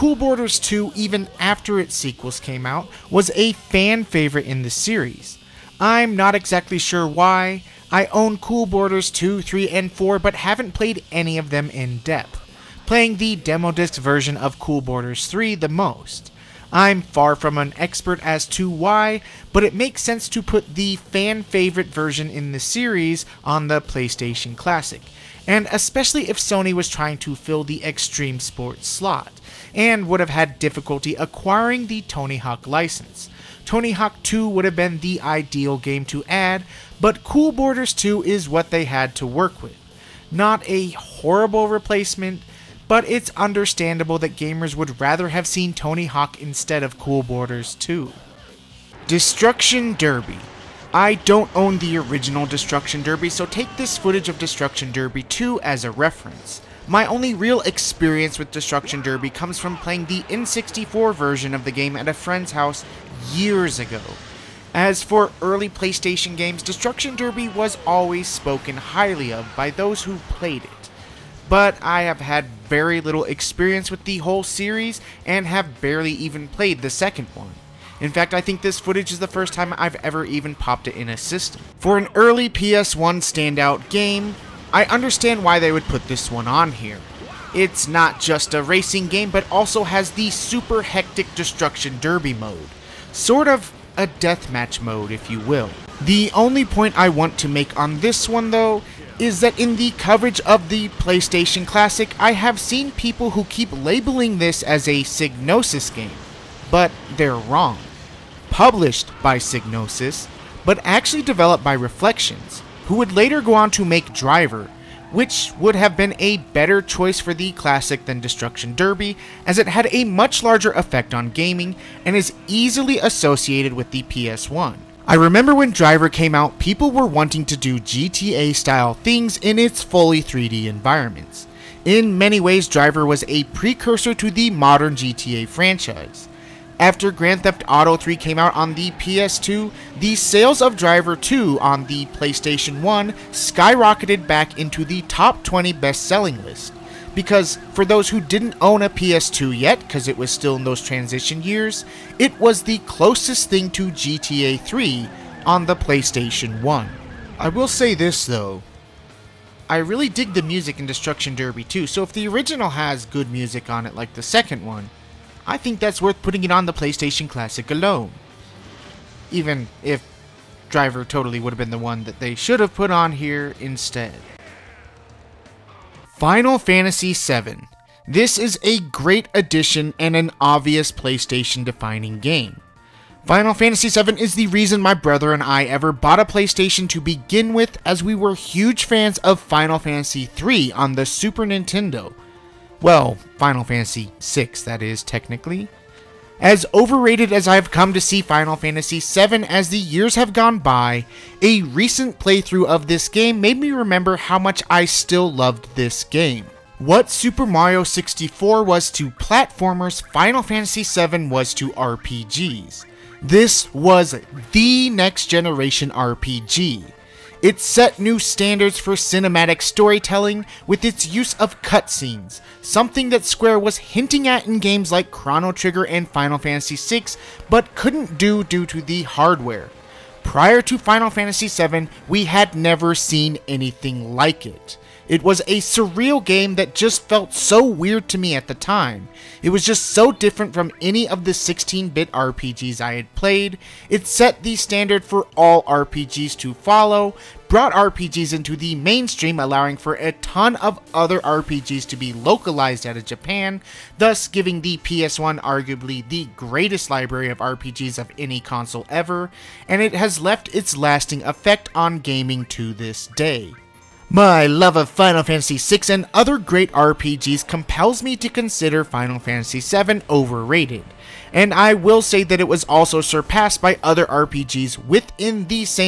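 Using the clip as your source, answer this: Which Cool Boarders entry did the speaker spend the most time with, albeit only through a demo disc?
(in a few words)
Cool Boarders 3.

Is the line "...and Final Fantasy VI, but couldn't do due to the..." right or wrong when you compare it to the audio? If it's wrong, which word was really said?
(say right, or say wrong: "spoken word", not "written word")
right.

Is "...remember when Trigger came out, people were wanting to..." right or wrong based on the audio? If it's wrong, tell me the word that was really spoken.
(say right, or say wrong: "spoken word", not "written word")
wrong: "Driver", not "Trigger".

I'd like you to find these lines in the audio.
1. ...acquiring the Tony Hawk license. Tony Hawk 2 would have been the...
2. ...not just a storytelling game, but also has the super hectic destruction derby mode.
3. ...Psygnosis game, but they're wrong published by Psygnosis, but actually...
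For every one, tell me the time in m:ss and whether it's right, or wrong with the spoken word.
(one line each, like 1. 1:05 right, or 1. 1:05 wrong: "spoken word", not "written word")
1. 0:31 right
2. 1:27 wrong: "racing", not "storytelling"
3. 1:45 right.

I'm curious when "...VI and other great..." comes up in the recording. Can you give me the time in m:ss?
4:25.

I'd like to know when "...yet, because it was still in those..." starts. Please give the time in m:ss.
2:29.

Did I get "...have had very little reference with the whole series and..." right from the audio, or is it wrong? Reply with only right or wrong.
wrong.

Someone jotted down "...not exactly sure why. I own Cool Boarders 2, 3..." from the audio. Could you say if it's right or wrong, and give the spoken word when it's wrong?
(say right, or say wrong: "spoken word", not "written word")
right.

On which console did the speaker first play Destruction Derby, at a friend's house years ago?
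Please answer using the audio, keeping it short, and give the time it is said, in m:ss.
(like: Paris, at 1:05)
N64, at 1:00.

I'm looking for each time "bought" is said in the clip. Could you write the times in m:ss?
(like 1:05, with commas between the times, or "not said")
3:05.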